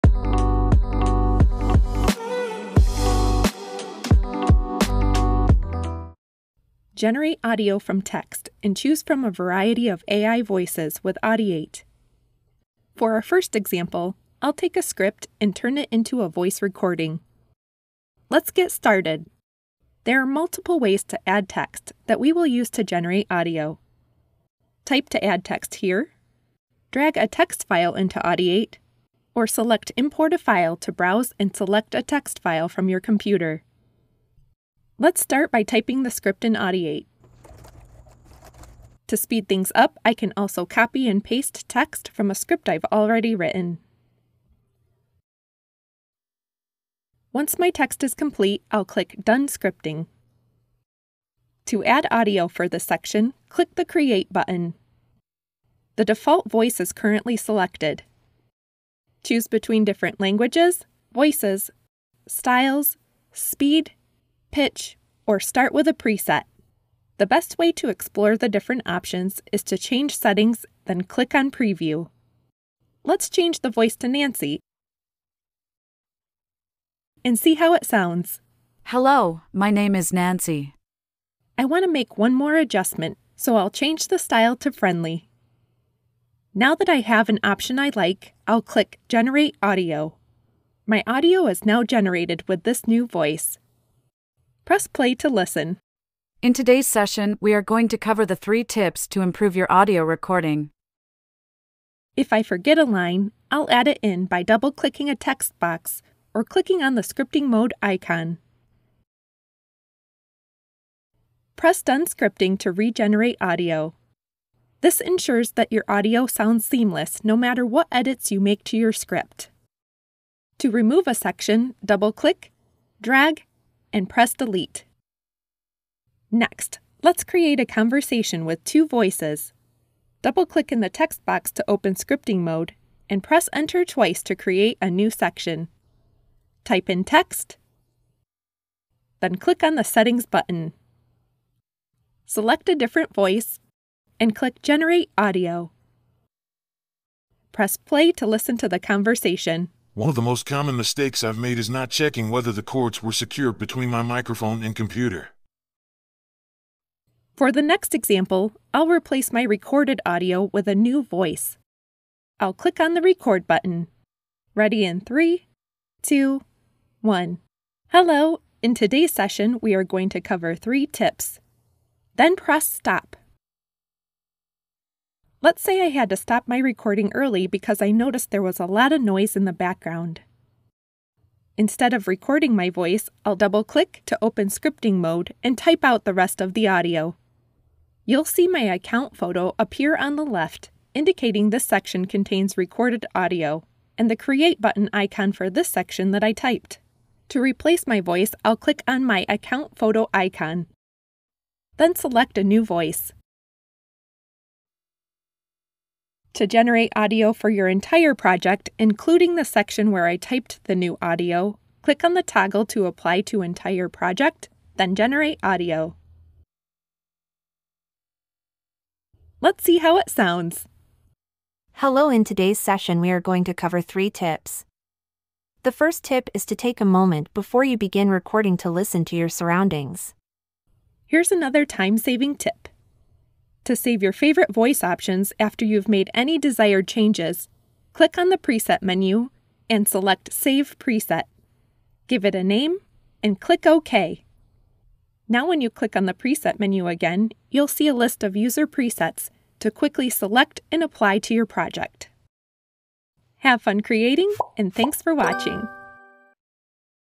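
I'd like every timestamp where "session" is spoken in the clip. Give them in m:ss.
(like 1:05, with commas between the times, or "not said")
1:36, 2:49, 3:42.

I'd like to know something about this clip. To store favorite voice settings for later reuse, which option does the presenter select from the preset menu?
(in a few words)
Save Preset.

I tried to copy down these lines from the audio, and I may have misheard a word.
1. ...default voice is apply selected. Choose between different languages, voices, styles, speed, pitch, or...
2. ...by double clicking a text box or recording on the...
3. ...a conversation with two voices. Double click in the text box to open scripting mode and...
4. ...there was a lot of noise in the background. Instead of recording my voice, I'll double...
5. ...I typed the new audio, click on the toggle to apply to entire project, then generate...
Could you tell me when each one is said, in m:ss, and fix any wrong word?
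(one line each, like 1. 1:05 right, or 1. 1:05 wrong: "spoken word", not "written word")
1. 0:56 wrong: "currently", not "apply"
2. 1:44 wrong: "clicking", not "recording"
3. 2:07 right
4. 2:58 right
5. 3:30 right.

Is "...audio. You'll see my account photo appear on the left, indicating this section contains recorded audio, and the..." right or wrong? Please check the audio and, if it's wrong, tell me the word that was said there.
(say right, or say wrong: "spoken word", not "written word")
right.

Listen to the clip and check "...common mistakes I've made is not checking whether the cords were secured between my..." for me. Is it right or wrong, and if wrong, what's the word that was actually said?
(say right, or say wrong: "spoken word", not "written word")
right.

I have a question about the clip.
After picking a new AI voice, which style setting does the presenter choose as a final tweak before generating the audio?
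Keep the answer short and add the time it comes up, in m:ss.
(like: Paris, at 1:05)
friendly, at 1:24.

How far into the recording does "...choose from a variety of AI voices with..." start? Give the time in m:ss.
0:08.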